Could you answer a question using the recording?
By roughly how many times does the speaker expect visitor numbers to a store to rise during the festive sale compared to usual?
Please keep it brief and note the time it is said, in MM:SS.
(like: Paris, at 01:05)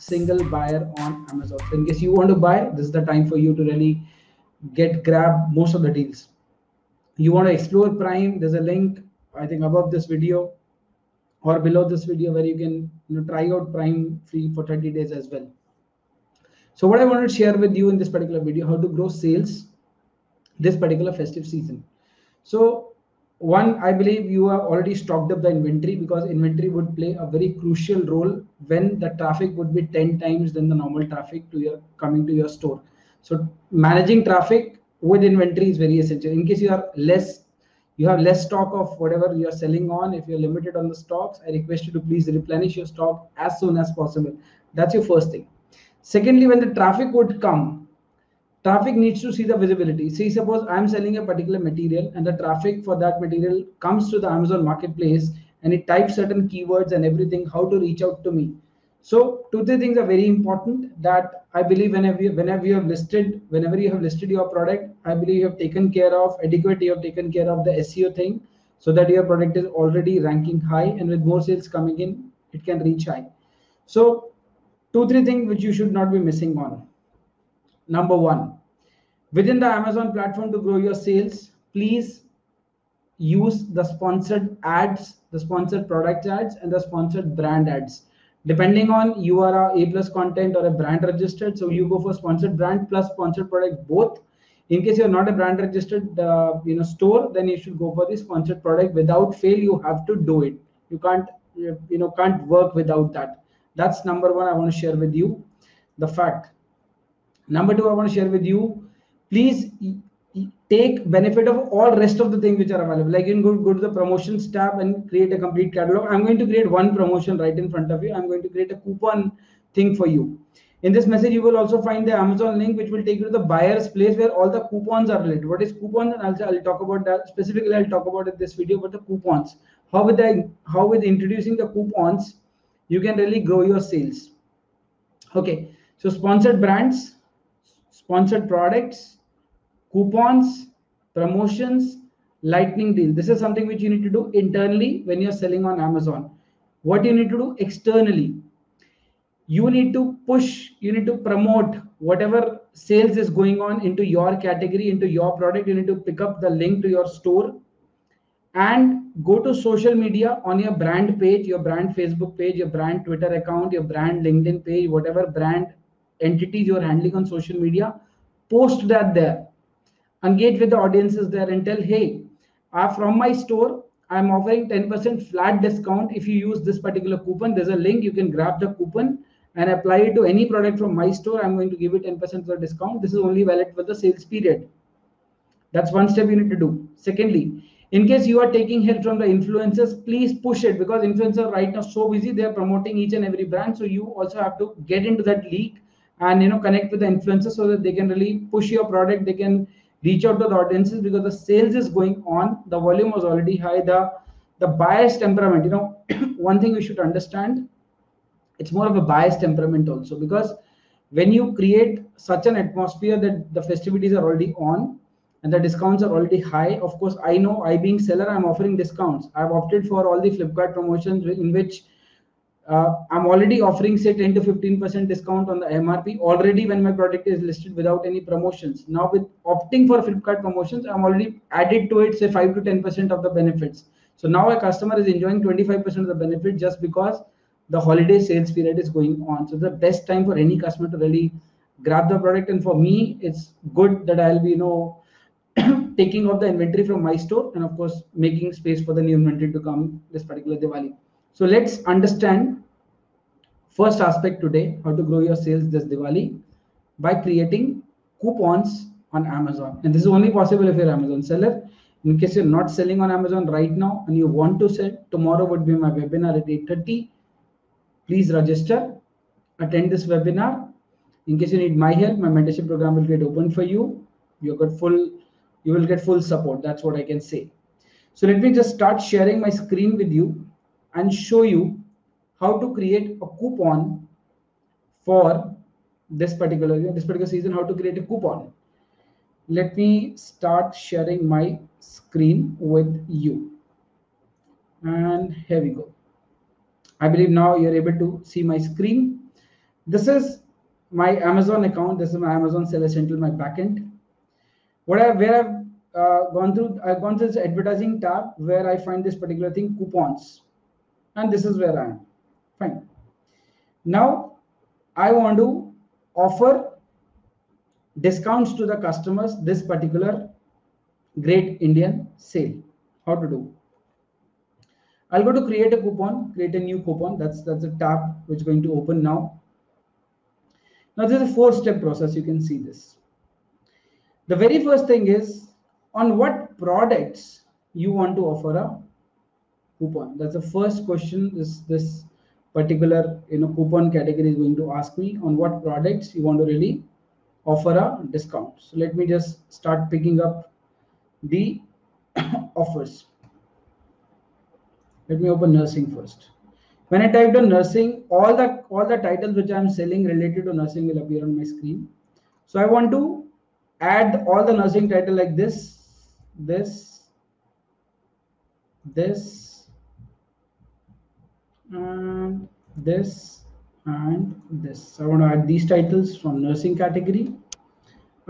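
10, at 00:29.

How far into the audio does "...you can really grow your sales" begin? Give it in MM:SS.
02:12.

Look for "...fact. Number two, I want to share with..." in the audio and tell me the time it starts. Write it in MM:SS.
01:46.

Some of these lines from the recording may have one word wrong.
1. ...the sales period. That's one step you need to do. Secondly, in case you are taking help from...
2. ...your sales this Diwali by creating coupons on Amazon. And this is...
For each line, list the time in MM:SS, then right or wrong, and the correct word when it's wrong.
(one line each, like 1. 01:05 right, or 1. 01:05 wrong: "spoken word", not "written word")
1. 03:03 right
2. 04:15 right.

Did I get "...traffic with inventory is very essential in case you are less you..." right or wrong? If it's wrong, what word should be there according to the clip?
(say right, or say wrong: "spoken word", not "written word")
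right.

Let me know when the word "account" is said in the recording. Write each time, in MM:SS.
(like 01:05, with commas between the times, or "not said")
02:43, 05:01.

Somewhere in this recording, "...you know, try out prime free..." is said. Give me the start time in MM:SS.
00:13.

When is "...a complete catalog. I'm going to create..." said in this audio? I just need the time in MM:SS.
01:55.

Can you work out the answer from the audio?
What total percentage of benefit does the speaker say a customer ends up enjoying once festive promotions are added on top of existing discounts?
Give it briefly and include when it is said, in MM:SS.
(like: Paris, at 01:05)
25%, at 03:55.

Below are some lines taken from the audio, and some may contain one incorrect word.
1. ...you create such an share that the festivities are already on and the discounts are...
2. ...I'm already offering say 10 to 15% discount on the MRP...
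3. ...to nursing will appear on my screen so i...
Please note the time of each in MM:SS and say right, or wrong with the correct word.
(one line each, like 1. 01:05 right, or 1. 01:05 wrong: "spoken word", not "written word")
1. 03:31 wrong: "atmosphere", not "share"
2. 03:43 right
3. 06:00 right.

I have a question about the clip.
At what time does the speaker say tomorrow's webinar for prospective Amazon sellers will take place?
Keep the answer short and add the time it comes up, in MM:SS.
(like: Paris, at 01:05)
8:30, at 04:26.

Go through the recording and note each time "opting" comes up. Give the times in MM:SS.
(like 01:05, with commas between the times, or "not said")
03:49.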